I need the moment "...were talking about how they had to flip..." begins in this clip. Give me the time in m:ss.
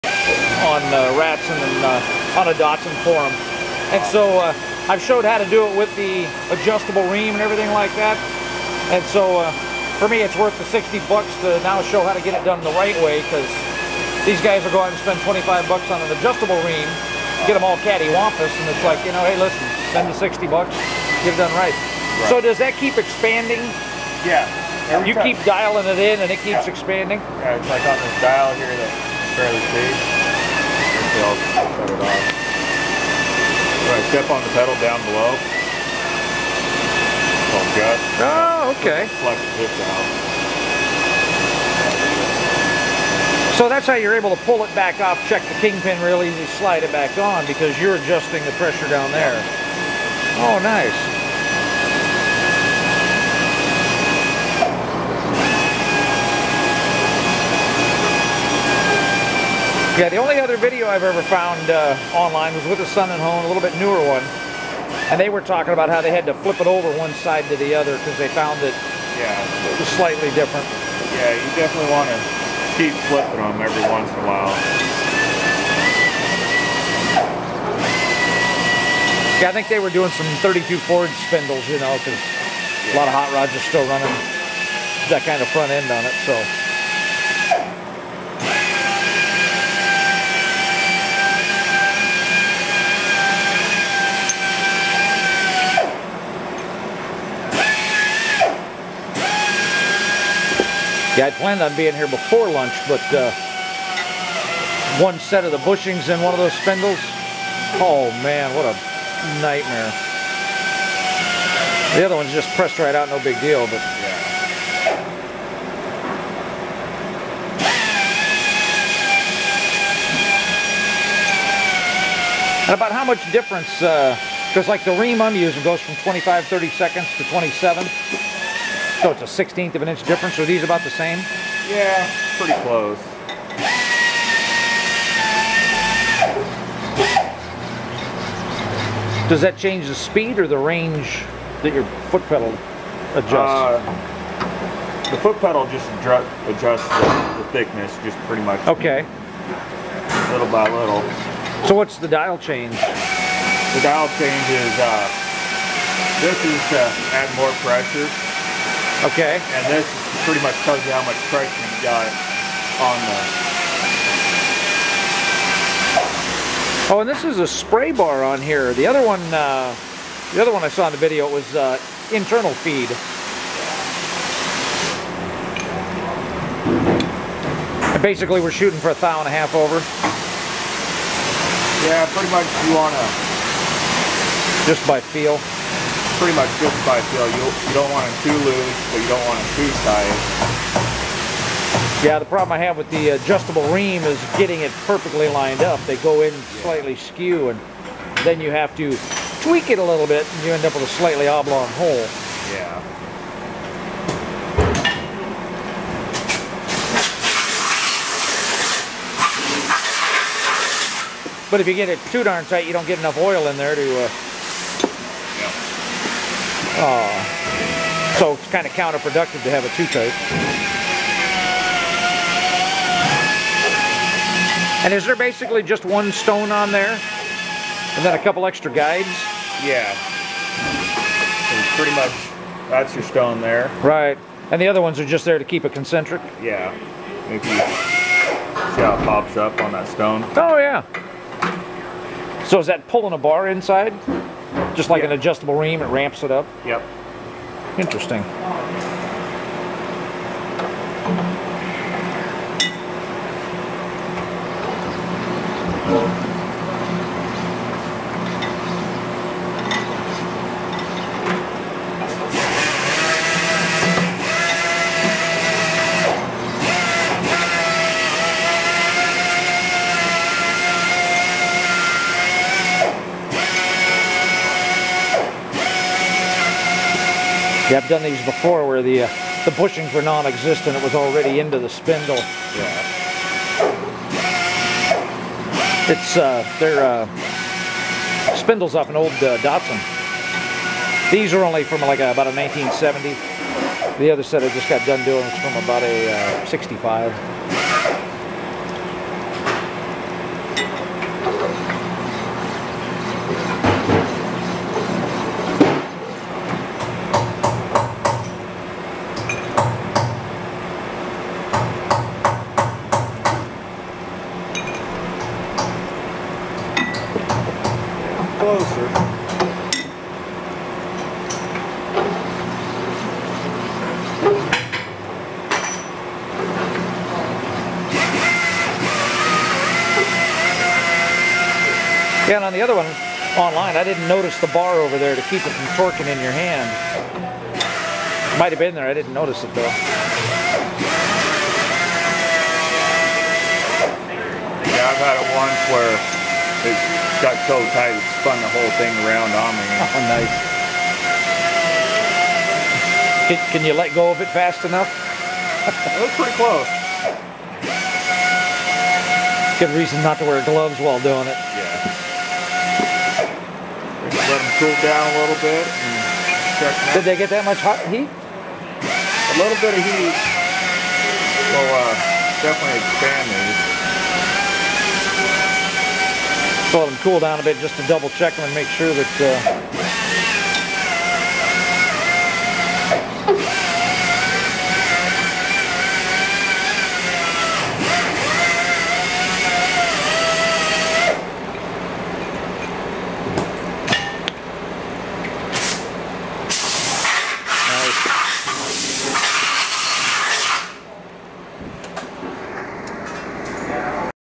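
1:05.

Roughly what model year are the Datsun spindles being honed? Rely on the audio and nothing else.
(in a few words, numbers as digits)
1970.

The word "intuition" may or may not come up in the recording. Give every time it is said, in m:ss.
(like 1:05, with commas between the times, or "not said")
not said.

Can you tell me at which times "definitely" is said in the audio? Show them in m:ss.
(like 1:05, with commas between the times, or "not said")
1:11, 6:12.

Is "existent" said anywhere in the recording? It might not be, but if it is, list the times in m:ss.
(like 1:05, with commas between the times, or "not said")
4:40.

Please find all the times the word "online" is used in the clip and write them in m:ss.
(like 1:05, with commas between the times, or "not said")
1:02, 5:33.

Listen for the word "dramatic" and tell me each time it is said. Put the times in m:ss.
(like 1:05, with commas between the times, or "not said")
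not said.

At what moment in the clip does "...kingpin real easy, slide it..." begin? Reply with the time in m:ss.
0:45.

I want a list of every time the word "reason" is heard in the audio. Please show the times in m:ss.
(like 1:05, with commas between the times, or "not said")
5:59.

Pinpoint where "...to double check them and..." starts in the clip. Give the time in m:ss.
6:17.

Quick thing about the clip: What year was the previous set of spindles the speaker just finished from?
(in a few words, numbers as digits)
65.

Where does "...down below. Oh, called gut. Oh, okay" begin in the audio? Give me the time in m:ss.
0:34.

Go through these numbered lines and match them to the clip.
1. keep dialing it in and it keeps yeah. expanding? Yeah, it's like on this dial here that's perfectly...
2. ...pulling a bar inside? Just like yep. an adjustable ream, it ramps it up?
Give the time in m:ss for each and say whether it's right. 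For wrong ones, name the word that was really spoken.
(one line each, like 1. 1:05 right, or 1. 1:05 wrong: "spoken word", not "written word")
1. 0:25 wrong: "fairly", not "perfectly"
2. 4:02 right.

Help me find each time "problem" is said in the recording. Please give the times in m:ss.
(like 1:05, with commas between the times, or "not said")
3:12.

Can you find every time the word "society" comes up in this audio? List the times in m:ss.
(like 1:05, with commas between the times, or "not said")
not said.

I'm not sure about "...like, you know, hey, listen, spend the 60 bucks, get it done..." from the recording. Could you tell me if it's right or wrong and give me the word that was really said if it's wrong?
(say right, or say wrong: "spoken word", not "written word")
right.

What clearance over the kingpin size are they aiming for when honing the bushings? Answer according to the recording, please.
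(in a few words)
a thou and a half.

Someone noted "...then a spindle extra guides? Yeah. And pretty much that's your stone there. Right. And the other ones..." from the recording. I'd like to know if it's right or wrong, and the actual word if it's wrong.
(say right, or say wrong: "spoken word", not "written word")
wrong: "couple", not "spindle".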